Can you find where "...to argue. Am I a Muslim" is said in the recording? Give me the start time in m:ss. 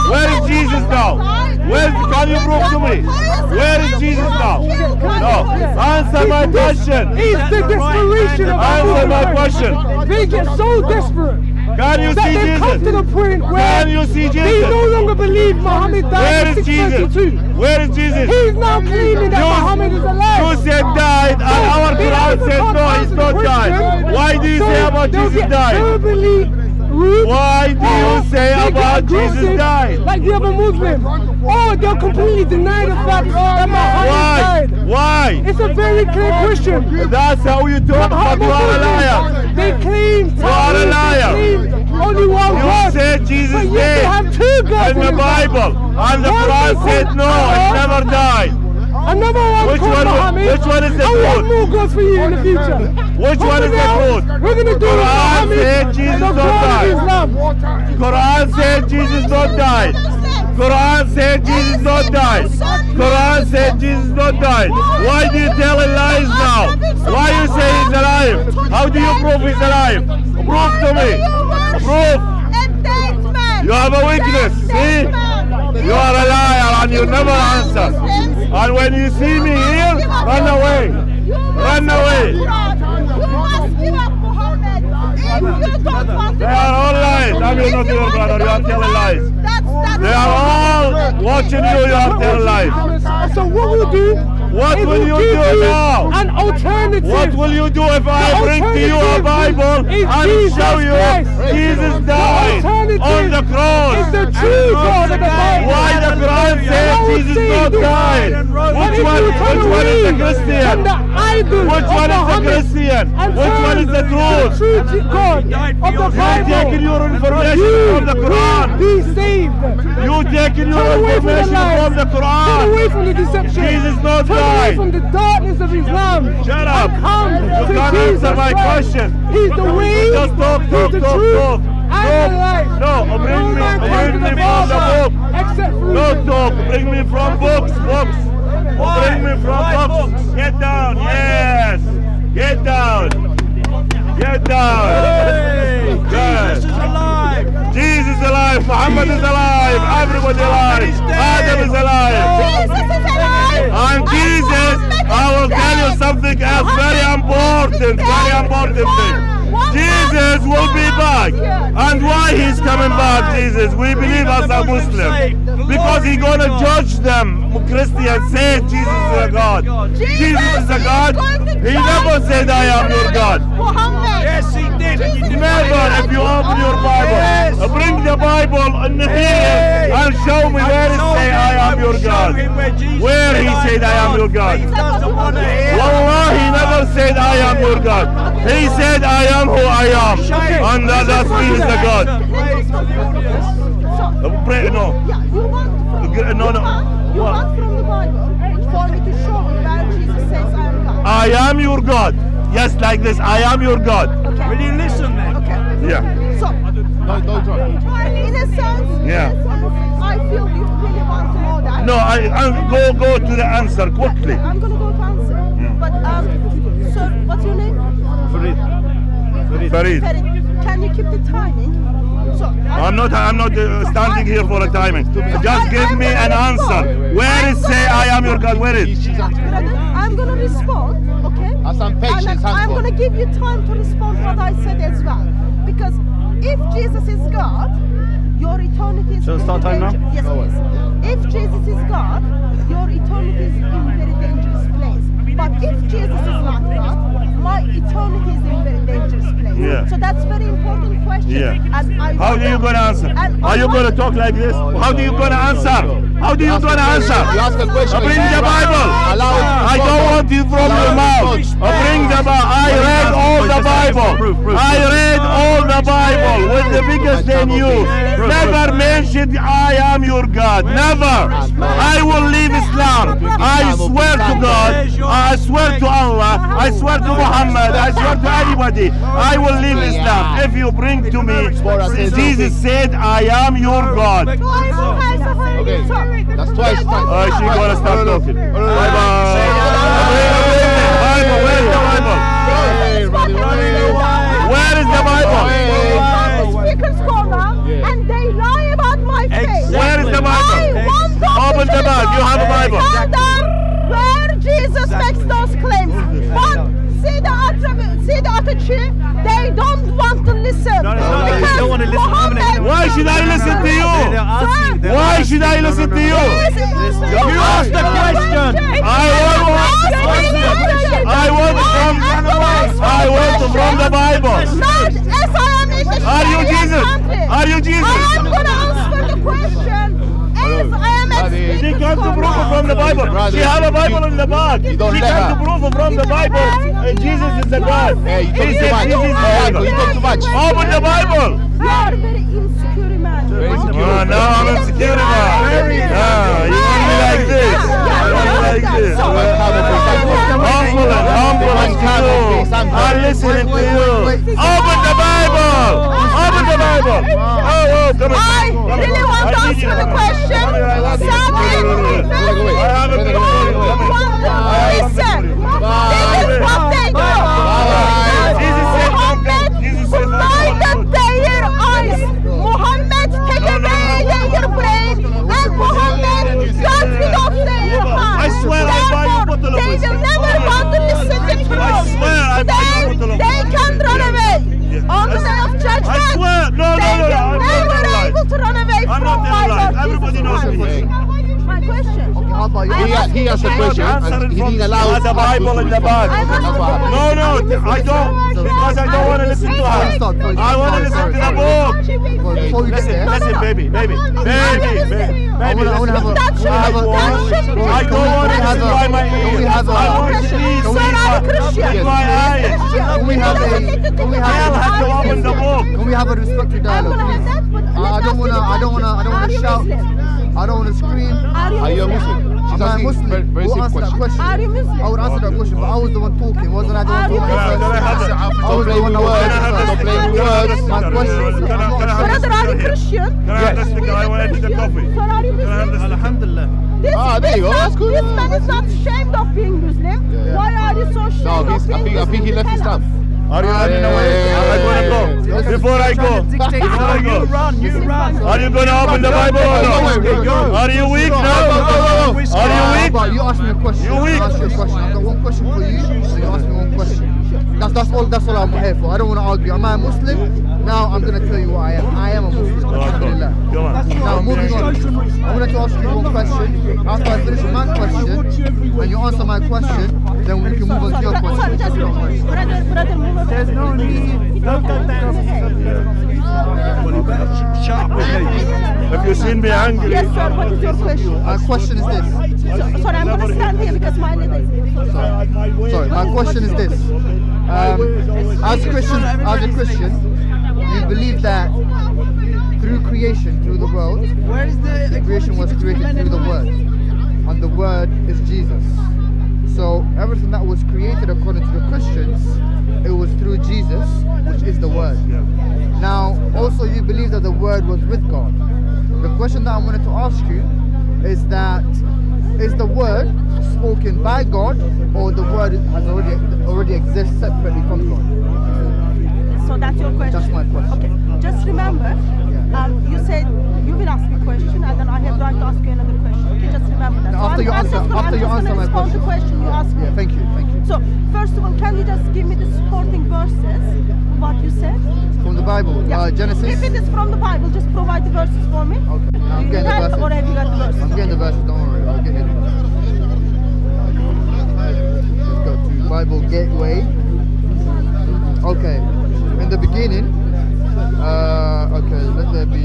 7:39.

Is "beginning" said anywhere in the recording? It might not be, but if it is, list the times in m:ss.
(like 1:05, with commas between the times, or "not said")
9:09.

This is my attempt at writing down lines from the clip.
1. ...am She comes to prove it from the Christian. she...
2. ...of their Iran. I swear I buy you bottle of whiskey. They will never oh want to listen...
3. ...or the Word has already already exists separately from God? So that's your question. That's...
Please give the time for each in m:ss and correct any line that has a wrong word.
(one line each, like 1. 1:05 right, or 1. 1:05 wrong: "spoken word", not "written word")
1. 5:31 wrong: "Bible", not "Christian"
2. 6:17 right
3. 8:34 right.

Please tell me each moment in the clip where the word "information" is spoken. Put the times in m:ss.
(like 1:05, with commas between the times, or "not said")
1:57, 2:01.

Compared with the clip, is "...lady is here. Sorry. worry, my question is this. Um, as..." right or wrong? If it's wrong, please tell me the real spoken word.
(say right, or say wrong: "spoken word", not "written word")
wrong: "sorry", not "worry".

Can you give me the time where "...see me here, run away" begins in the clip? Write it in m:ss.
1:19.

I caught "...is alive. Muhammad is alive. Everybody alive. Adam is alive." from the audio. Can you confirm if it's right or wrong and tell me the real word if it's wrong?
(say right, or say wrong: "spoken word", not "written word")
right.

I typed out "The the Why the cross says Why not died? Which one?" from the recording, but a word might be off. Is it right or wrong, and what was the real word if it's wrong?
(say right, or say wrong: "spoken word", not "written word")
wrong: "Jesus", not "Why".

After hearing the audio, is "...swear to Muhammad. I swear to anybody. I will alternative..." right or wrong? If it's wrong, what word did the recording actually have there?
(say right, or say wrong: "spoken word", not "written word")
wrong: "leave", not "alternative".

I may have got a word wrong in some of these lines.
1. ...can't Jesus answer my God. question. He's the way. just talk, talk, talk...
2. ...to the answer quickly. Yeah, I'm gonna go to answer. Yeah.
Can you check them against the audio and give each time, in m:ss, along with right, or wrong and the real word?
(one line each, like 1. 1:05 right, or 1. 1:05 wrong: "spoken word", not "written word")
1. 2:07 wrong: "Christ", not "God"
2. 3:33 right.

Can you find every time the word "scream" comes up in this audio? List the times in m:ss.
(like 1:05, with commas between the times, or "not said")
7:00.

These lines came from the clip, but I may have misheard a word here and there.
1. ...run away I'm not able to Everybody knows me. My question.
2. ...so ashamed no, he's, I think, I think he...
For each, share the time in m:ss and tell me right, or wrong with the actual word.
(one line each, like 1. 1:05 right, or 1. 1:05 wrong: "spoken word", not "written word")
1. 6:28 right
2. 7:20 right.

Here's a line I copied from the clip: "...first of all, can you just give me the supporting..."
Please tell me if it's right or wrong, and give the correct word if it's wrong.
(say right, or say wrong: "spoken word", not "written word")
right.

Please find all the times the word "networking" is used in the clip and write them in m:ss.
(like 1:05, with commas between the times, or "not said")
not said.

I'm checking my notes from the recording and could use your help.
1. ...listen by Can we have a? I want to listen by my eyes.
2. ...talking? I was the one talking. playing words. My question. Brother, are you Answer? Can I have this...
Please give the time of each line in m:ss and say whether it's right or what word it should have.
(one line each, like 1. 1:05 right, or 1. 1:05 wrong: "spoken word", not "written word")
1. 6:48 right
2. 7:07 wrong: "Christian", not "Answer".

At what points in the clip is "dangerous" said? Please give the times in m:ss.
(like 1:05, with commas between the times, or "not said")
4:04, 4:08.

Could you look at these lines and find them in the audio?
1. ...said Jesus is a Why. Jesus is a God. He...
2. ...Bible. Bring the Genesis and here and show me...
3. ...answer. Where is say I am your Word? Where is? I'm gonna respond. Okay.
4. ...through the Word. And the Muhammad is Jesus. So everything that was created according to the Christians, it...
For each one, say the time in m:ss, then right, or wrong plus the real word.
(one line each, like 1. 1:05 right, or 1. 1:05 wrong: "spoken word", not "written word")
1. 2:48 wrong: "God", not "Why"
2. 2:56 wrong: "Bible", not "Genesis"
3. 3:46 wrong: "God", not "Word"
4. 8:15 wrong: "Word", not "Muhammad".